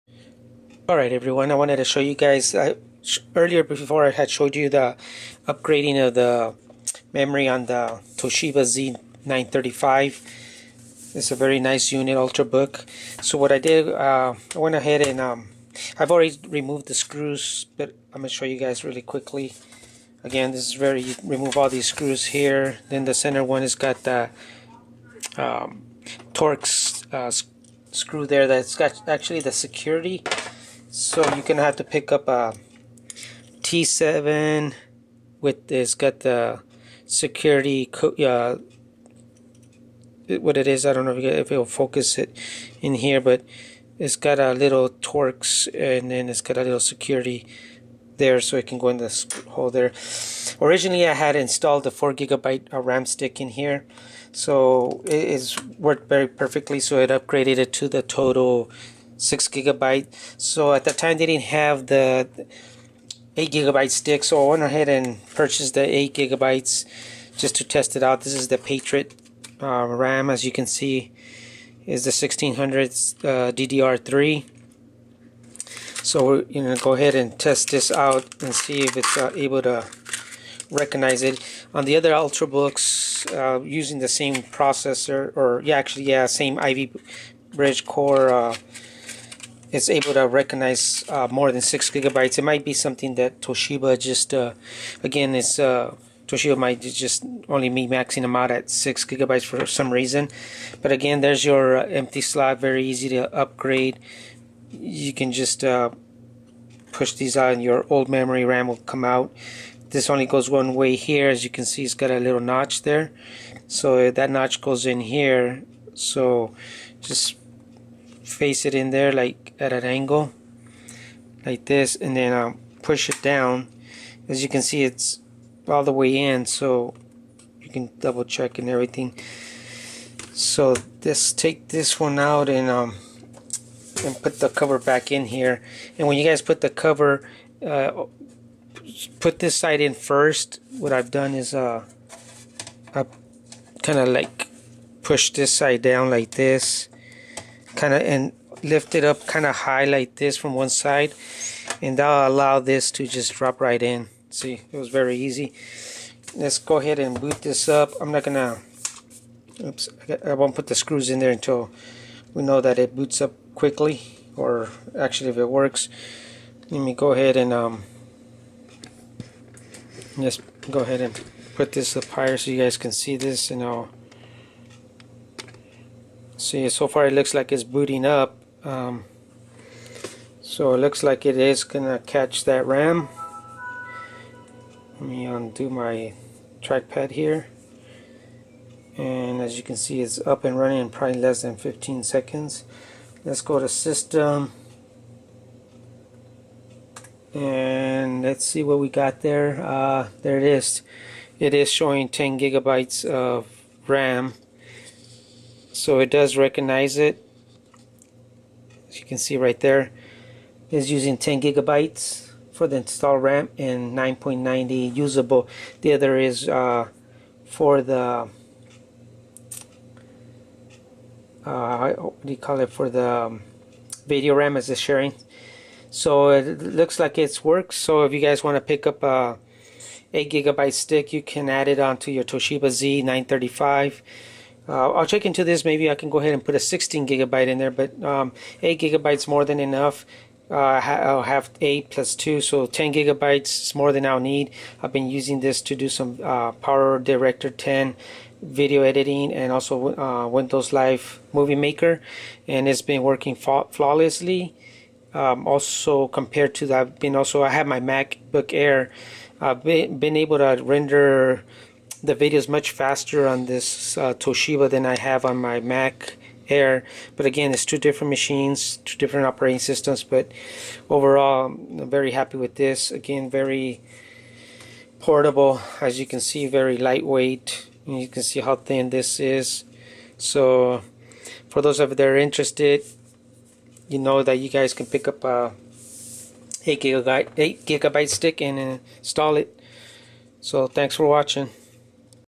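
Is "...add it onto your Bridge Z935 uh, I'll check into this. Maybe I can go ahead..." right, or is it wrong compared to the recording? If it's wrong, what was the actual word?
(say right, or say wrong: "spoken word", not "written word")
wrong: "Toshiba", not "Bridge".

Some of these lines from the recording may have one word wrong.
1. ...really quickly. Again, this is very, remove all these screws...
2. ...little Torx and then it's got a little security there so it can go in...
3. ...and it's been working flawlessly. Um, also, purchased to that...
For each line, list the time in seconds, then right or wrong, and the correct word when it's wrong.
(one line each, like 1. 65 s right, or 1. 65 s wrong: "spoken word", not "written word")
1. 18 s right
2. 44 s right
3. 252 s wrong: "compared", not "purchased".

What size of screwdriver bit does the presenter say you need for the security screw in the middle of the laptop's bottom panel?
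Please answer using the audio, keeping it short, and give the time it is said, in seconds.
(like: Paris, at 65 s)
T7, at 33 s.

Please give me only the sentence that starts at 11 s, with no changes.
It's a very nice unit, Ultrabook.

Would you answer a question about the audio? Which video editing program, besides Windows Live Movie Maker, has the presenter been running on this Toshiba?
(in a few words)
Power Director 10.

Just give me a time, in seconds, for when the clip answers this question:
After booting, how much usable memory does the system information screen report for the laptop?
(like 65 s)
213 s.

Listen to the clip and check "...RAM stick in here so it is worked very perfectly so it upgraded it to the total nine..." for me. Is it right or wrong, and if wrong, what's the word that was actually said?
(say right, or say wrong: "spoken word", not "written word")
wrong: "six", not "nine".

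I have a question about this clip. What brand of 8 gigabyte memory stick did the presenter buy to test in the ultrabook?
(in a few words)
Patriot.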